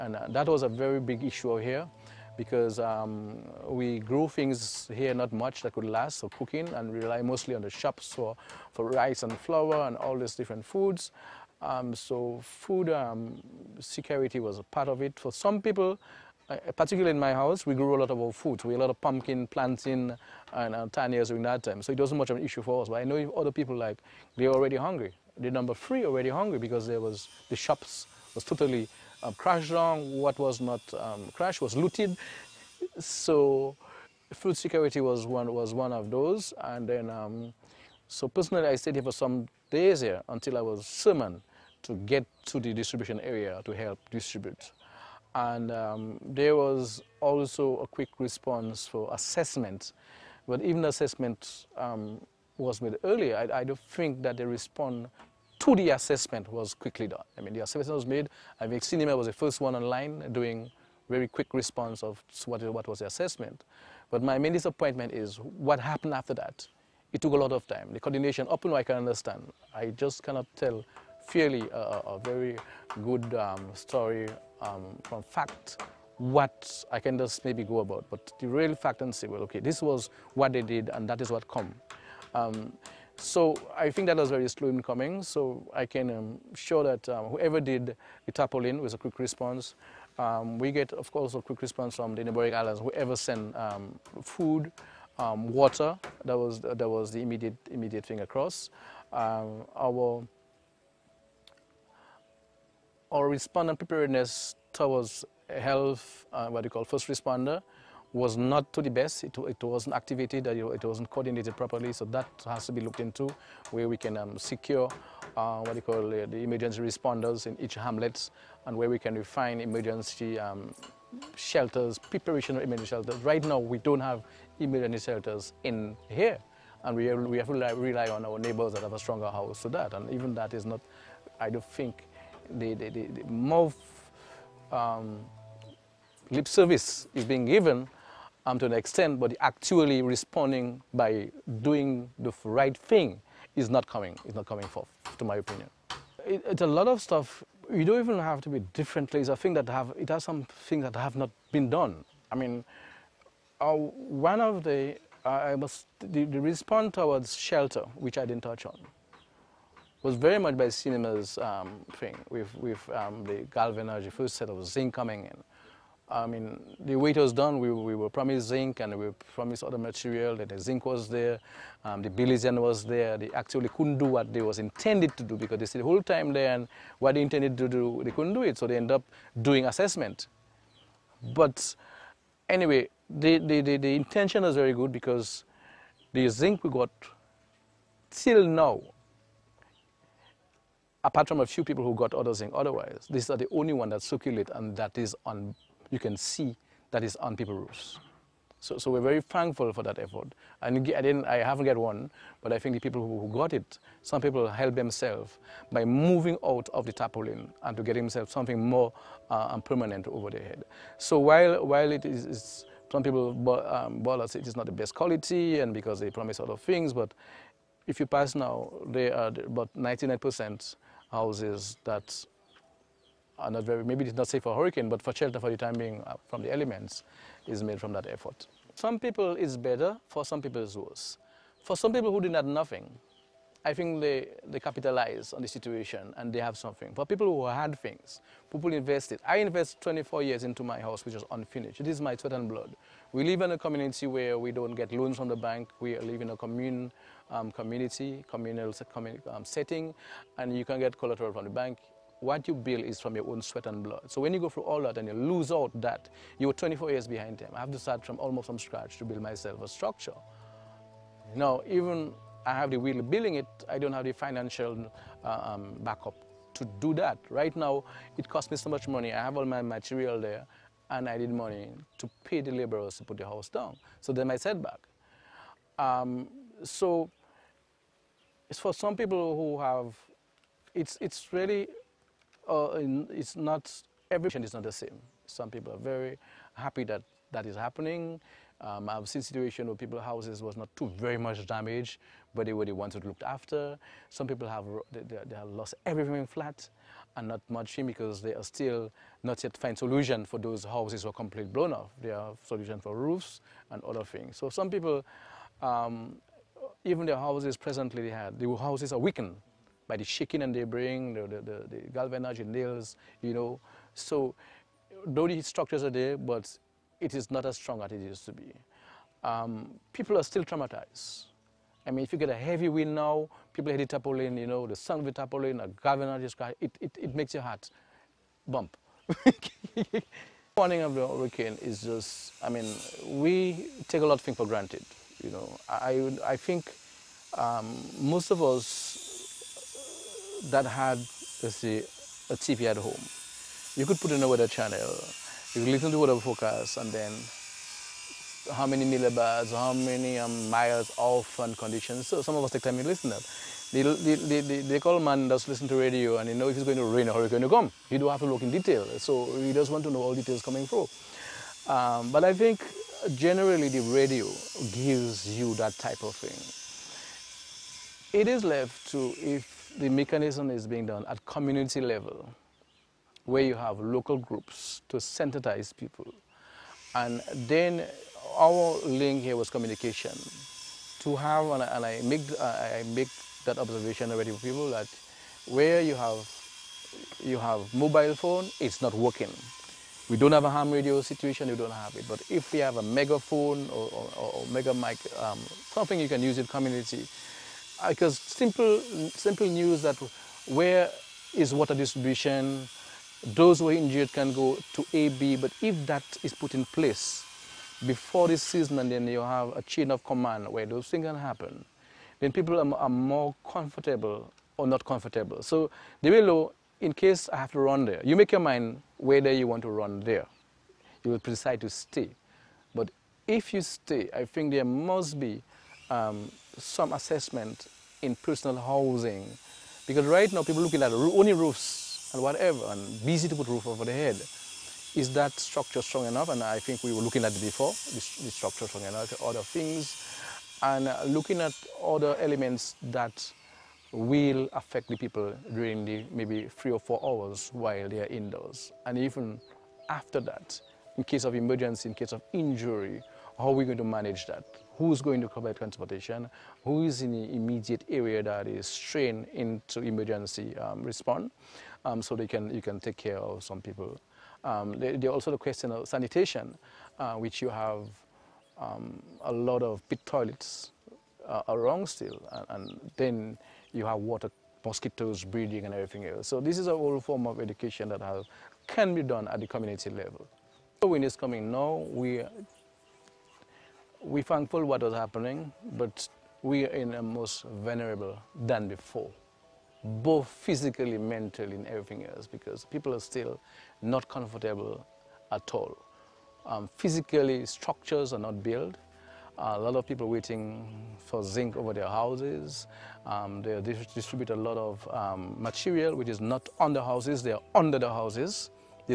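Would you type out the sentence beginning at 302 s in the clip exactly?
They have solution for roofs and other things.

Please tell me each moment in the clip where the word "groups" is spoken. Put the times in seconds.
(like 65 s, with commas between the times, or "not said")
374 s.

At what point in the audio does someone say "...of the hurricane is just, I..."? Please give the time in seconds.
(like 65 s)
330 s.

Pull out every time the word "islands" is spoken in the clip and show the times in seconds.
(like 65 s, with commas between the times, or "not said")
92 s.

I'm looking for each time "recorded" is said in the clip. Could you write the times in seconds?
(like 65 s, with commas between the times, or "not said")
not said.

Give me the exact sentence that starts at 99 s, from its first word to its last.
Um, our our respondent preparedness towards health, uh, what you call first responder, was not to the best.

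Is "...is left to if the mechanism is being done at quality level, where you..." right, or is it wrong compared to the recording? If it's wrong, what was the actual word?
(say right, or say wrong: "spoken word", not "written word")
wrong: "community", not "quality".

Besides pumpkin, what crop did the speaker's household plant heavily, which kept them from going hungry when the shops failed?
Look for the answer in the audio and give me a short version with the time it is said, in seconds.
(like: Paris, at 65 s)
tannias, at 20 s.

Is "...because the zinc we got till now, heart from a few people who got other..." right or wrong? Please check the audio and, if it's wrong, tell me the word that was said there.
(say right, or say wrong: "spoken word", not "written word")
wrong: "apart", not "heart".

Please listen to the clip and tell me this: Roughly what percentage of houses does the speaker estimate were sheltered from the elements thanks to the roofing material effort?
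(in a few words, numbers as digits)
99%.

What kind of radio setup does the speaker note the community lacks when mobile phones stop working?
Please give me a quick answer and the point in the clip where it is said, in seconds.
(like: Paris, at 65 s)
ham radio, at 390 s.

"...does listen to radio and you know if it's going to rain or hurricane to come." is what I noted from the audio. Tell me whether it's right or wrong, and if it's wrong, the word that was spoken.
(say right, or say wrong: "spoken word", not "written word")
right.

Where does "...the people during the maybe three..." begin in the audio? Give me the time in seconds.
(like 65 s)
444 s.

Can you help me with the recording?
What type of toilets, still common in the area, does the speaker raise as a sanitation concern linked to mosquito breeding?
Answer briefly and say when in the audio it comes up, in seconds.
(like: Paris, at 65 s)
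pit toilets, at 469 s.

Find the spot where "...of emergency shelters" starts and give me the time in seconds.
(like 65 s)
122 s.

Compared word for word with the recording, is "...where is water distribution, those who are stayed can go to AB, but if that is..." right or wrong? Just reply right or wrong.
wrong.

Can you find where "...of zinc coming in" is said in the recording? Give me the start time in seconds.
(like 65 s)
164 s.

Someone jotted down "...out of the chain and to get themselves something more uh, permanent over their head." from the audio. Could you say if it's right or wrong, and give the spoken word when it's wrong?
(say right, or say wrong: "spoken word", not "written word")
wrong: "tarpaulin", not "chain".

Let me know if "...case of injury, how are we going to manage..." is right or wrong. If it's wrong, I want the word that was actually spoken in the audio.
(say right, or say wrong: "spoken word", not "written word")
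right.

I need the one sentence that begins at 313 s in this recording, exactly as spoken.
So though the structures are there, but it is not as strong as it used to be.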